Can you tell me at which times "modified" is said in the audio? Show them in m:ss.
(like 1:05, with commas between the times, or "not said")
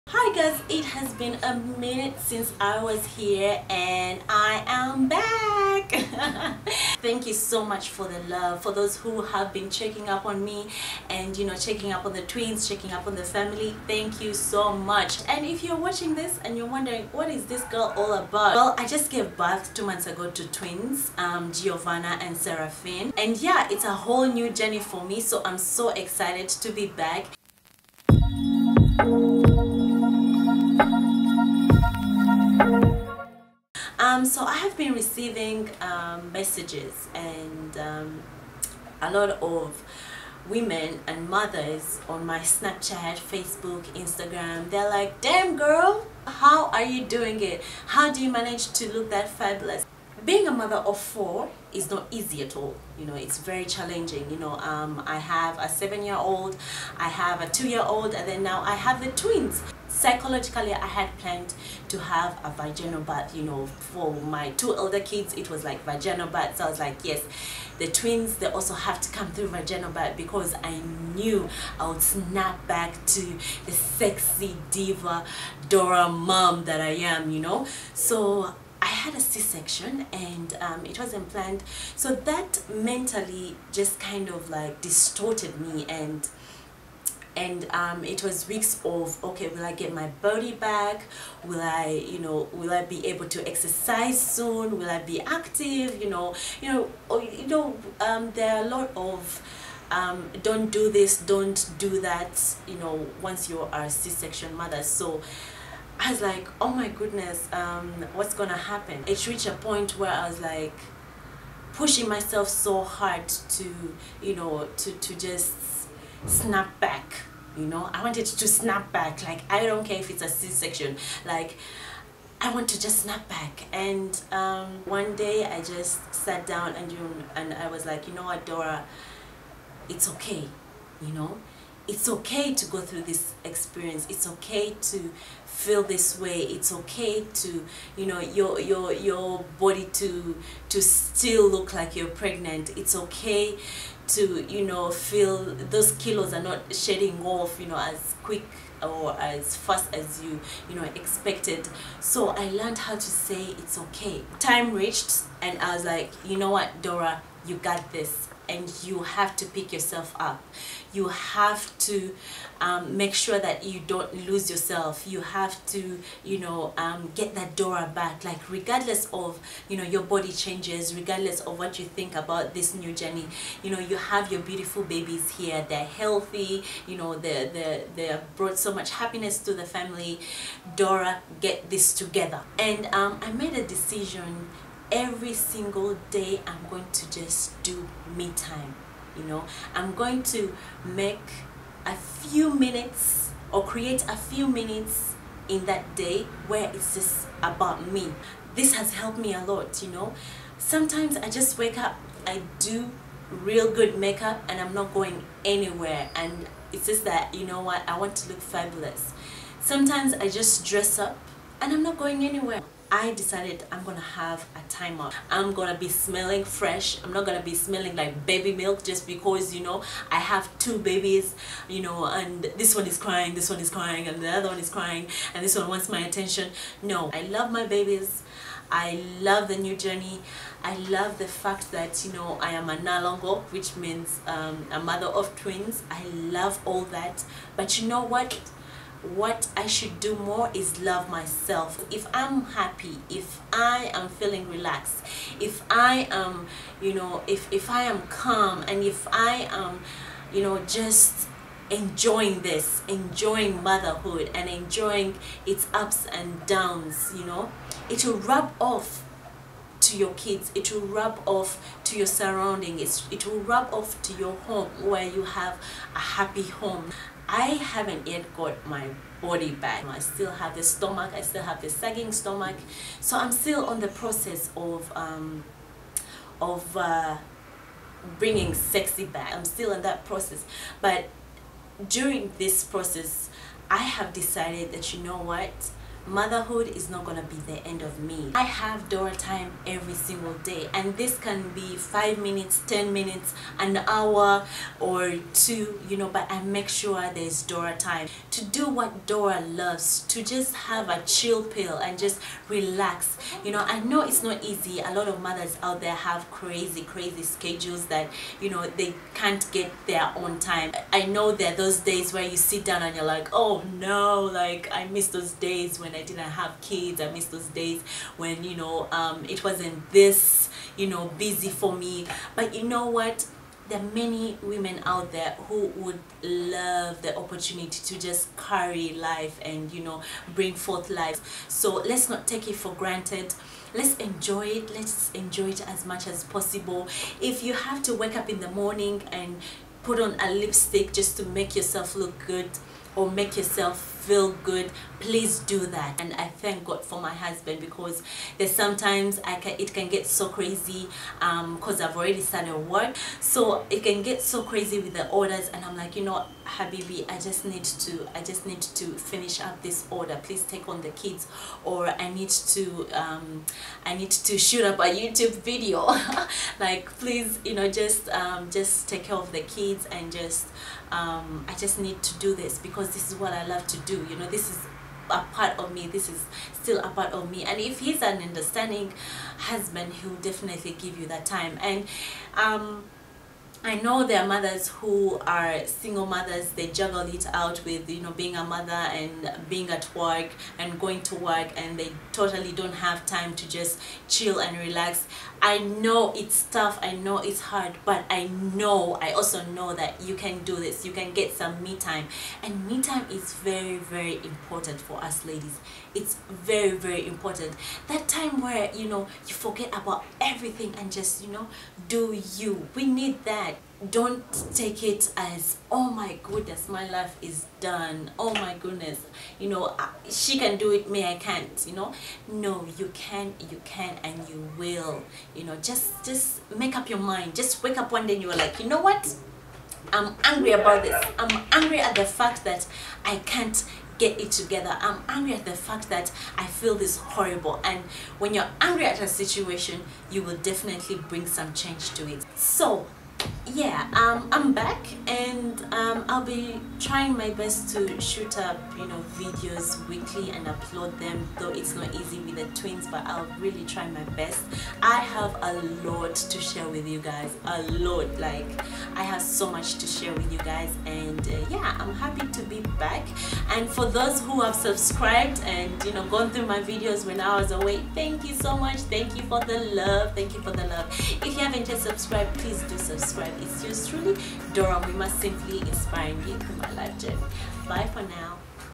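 not said.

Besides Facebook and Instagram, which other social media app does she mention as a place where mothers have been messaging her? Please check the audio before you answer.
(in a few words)
Snapchat.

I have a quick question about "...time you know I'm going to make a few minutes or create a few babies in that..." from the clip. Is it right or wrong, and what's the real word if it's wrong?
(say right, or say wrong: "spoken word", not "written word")
wrong: "minutes", not "babies".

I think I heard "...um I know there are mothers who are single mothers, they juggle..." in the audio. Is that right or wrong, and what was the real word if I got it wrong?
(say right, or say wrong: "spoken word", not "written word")
right.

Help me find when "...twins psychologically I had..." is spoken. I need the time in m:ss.
0:59.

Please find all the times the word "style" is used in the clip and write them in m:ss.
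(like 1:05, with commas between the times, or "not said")
not said.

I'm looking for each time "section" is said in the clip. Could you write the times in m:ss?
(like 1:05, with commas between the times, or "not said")
1:19, 1:43, 2:00.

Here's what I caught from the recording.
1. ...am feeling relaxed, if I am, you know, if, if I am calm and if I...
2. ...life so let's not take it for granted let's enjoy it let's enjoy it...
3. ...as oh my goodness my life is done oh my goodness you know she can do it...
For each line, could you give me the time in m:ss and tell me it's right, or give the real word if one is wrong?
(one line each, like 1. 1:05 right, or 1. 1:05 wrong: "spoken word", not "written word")
1. 4:03 right
2. 5:30 right
3. 6:55 right.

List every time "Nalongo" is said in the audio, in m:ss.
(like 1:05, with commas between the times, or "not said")
3:52.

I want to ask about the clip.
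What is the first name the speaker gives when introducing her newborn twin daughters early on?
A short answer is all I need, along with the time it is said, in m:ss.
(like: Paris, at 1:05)
Giovanna, at 0:21.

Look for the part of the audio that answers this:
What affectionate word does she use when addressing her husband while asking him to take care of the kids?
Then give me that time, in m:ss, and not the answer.
5:56.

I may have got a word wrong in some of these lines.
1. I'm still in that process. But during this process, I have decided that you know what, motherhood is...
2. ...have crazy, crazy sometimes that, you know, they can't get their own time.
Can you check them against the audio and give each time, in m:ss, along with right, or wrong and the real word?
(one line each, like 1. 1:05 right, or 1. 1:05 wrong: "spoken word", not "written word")
1. 4:39 right
2. 5:05 wrong: "schedules", not "sometimes".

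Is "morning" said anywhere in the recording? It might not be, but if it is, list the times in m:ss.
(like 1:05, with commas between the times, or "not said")
5:38.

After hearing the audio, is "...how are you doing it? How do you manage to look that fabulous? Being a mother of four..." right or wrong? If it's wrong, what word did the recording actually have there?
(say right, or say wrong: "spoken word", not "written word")
right.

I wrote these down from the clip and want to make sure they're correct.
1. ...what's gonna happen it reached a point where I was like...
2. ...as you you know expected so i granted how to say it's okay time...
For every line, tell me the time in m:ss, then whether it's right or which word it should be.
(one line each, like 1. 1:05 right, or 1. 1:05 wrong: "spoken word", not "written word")
1. 1:48 right
2. 2:29 wrong: "learned", not "granted".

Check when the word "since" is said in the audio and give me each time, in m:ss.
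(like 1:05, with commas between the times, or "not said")
0:02.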